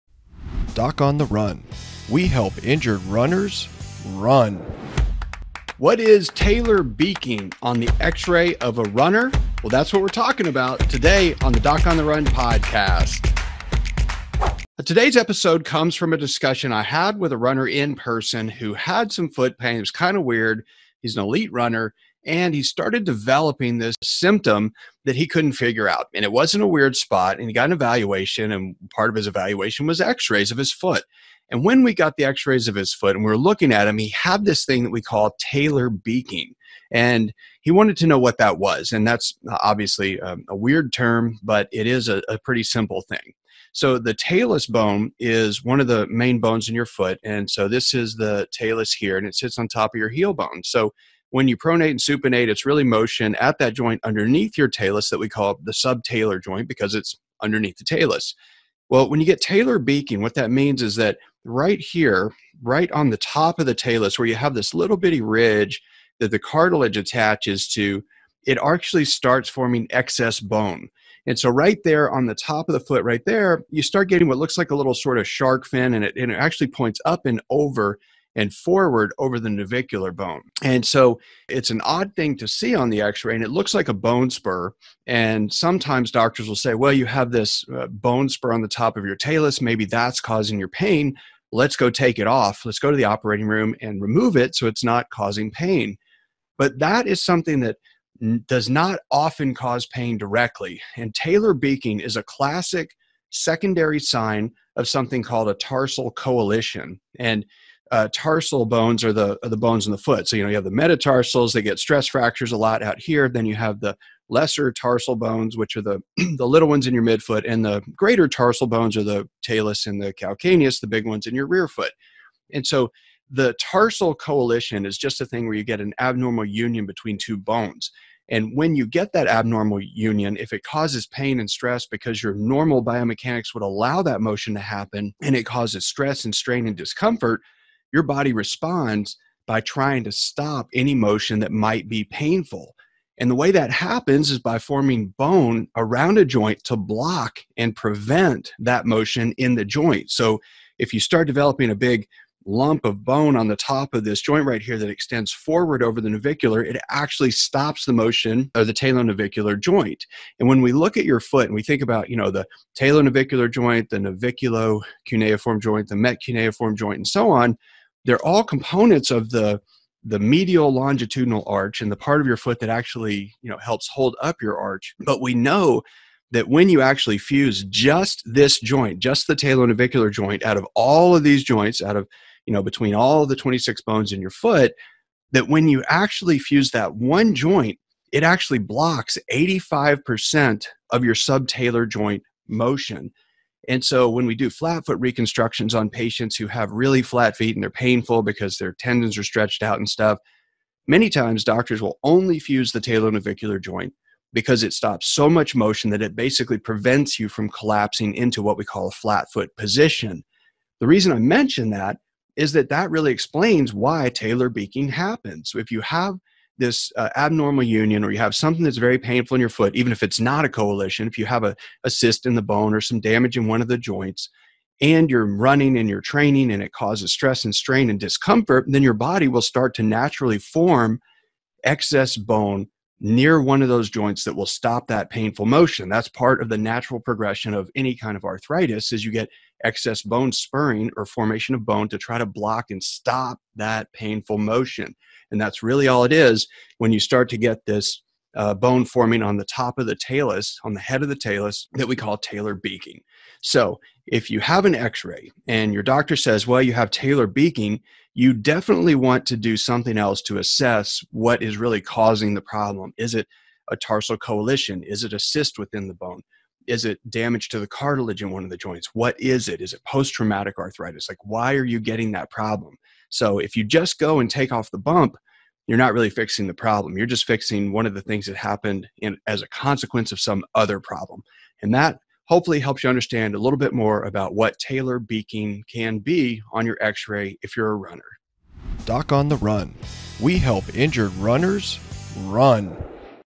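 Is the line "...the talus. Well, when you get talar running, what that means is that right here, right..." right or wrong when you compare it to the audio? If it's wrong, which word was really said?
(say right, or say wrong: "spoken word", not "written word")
wrong: "beaking", not "running".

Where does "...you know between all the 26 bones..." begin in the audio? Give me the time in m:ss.
3:02.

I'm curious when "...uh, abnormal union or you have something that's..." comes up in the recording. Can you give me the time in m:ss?
3:36.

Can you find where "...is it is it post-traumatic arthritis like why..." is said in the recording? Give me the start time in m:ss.
4:29.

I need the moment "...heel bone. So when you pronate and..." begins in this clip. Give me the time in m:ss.
0:50.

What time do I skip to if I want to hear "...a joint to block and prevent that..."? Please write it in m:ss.
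2:26.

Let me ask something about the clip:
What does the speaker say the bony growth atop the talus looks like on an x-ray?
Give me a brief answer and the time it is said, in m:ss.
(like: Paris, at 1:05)
shark fin, at 1:15.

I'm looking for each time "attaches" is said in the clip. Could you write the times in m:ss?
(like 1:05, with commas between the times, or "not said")
1:06.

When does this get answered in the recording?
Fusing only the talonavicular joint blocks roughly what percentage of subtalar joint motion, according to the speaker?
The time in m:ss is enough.
3:09.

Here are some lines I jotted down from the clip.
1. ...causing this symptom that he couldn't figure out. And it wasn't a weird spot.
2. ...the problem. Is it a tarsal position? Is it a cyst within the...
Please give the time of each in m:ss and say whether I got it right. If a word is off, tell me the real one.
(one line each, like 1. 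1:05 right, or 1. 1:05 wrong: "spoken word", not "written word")
1. 0:23 wrong: "developing", not "causing"
2. 4:22 wrong: "coalition", not "position".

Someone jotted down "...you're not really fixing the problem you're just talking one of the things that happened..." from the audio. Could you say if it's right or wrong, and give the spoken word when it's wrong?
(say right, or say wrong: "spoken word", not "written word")
wrong: "fixing", not "talking".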